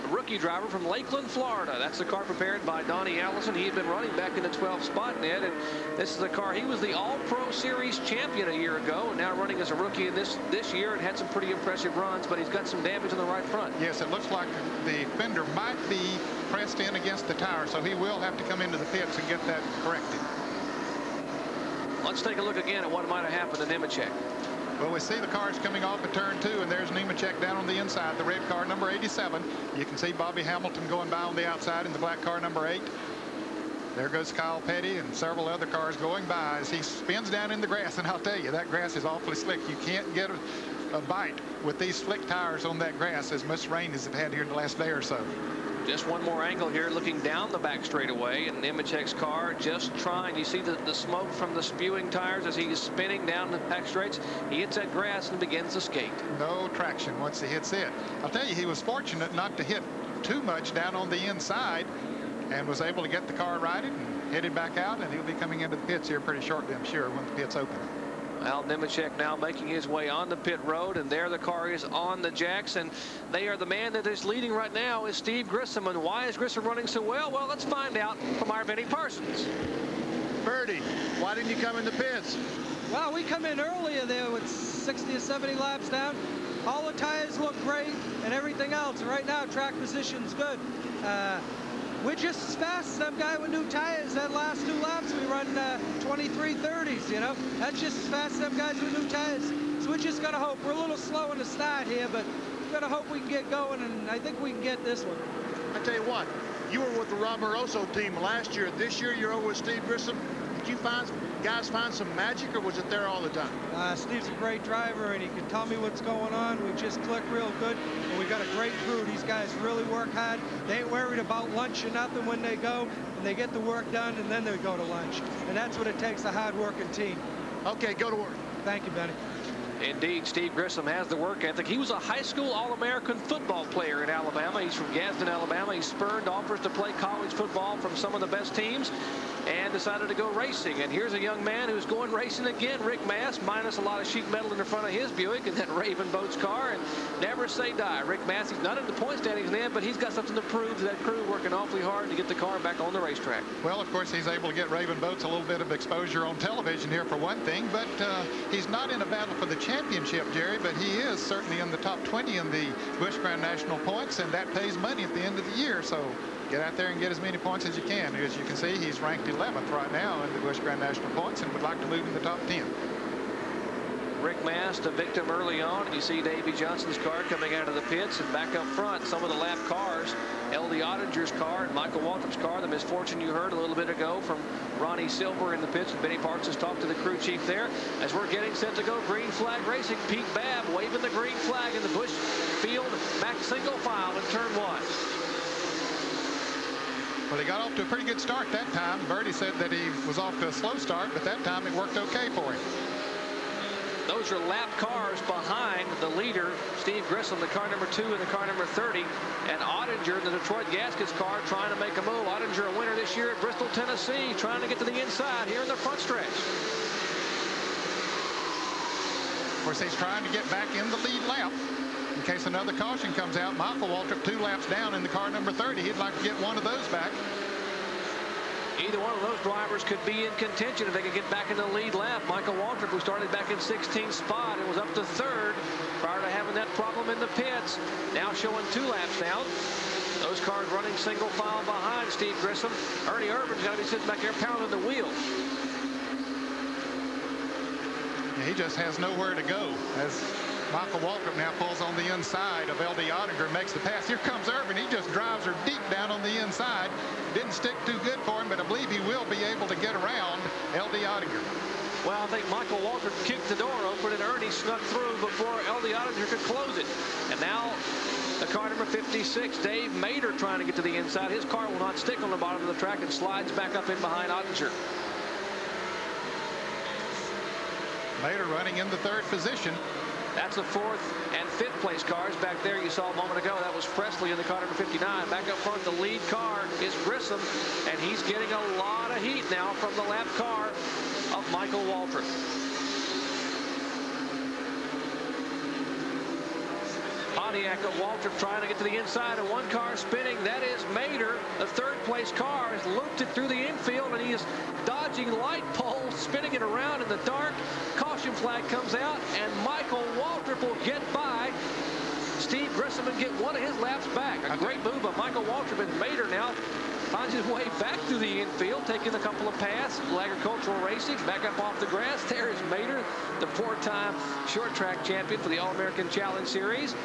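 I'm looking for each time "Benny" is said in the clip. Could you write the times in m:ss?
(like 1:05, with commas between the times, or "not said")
1:18, 2:08, 3:06.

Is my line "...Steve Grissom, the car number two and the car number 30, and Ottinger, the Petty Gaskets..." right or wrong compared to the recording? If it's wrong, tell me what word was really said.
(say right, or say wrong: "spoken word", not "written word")
wrong: "Detroit", not "Petty".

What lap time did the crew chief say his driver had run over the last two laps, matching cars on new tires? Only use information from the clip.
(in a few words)
23.30.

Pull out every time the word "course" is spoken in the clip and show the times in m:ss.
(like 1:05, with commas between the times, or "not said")
2:33, 3:39.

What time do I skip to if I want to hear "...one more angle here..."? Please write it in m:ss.
0:46.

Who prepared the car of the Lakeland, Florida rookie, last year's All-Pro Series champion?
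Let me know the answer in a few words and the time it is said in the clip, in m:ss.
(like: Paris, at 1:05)
Donnie Allison, at 0:02.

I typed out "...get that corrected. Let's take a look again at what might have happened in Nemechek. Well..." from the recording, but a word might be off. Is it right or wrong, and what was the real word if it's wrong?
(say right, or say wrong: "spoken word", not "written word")
right.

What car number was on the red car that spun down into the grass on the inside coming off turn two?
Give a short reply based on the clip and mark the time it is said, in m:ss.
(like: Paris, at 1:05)
87, at 0:28.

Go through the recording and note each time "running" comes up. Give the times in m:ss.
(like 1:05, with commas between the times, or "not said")
0:03, 0:09, 1:16, 4:00, 4:38.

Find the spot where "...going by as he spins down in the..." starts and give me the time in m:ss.
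0:35.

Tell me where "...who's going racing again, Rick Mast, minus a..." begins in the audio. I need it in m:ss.
2:21.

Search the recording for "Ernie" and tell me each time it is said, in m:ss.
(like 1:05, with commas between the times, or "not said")
4:03, 4:24.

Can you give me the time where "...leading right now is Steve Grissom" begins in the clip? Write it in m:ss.
1:14.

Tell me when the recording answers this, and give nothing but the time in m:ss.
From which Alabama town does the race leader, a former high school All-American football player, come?
2:14.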